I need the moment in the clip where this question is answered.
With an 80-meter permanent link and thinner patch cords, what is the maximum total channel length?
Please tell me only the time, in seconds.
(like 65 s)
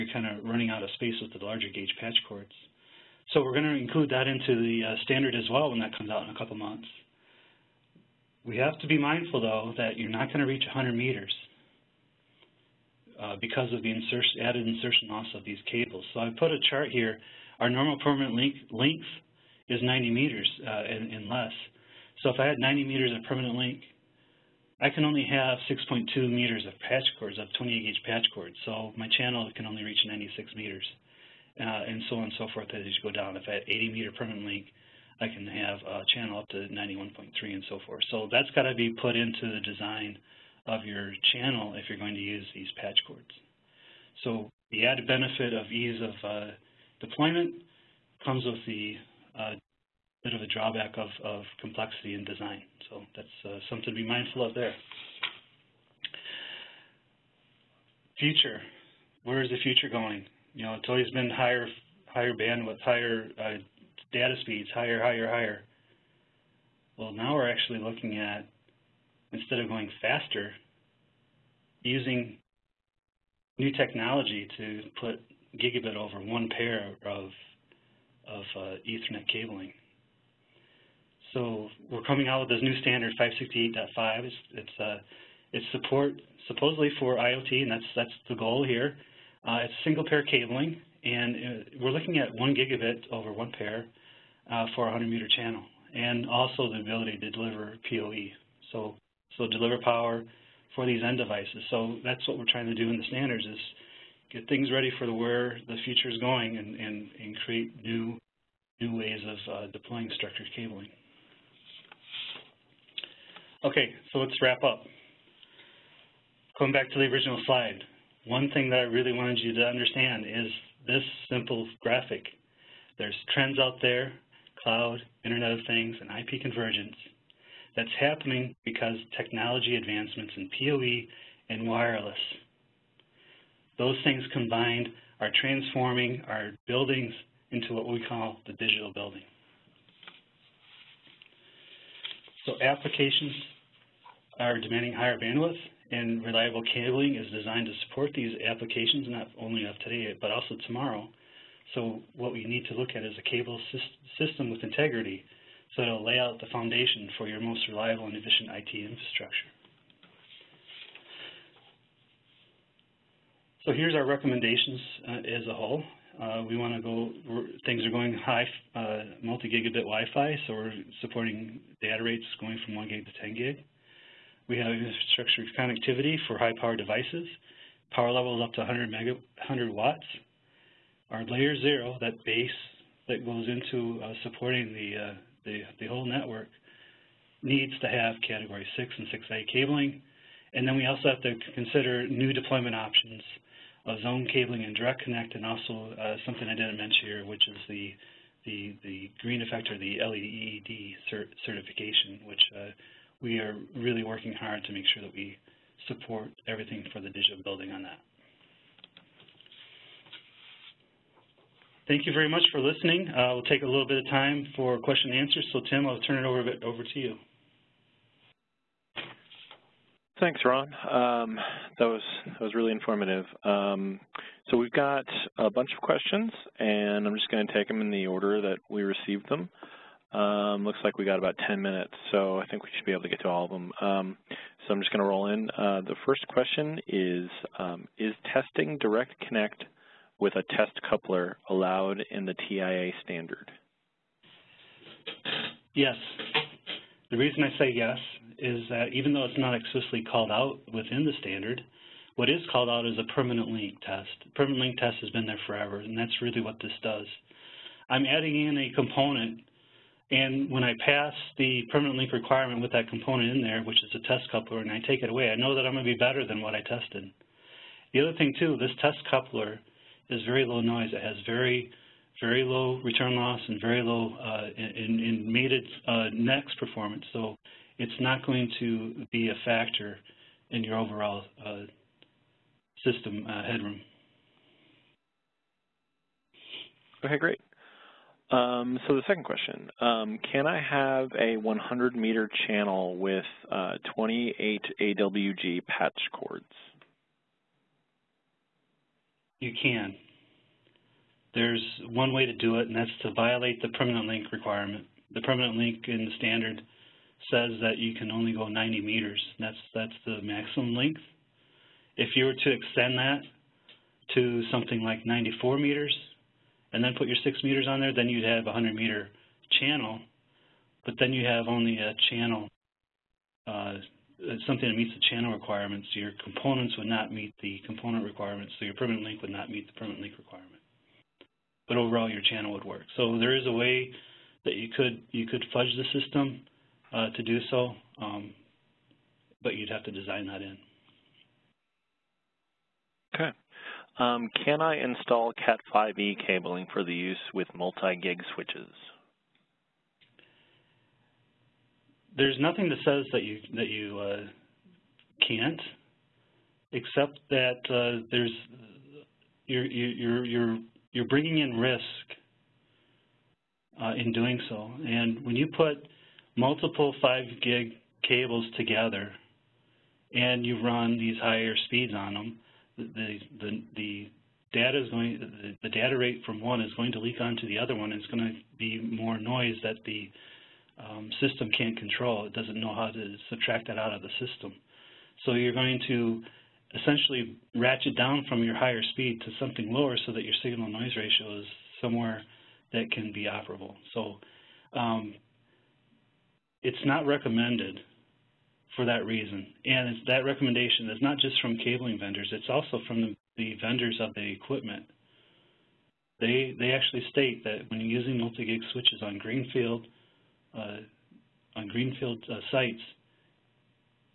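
36 s.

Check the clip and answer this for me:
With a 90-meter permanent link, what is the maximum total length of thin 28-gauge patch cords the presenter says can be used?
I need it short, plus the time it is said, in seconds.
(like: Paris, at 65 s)
6.2 meters, at 25 s.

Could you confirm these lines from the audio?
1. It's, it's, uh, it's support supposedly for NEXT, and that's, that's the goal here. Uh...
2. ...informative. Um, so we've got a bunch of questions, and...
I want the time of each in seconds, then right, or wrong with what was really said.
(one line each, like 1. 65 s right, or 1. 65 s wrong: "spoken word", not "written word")
1. 84 s wrong: "IoT", not "NEXT"
2. 222 s right.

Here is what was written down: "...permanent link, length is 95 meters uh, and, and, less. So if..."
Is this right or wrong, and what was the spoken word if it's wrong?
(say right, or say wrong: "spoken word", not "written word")
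wrong: "90", not "95".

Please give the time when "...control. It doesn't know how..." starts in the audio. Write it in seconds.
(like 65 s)
381 s.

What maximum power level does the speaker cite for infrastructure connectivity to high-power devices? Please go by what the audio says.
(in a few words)
100 watts.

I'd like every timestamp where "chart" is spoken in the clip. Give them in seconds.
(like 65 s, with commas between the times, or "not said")
16 s.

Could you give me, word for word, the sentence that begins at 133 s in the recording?
Those things combined are transforming our buildings into what we call the digital building.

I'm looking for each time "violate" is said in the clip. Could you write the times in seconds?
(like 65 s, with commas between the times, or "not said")
303 s.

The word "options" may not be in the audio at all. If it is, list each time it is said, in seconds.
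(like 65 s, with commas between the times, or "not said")
192 s.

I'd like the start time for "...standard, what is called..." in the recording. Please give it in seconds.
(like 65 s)
251 s.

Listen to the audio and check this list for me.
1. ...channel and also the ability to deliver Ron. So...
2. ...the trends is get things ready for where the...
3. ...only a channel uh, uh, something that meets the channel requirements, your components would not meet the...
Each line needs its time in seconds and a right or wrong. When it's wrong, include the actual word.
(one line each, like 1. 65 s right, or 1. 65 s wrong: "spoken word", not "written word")
1. 95 s wrong: "PoE", not "Ron"
2. 102 s wrong: "standards", not "trends"
3. 321 s right.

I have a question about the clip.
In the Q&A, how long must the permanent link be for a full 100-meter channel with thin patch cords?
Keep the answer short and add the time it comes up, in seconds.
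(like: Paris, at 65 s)
94 meters, at 315 s.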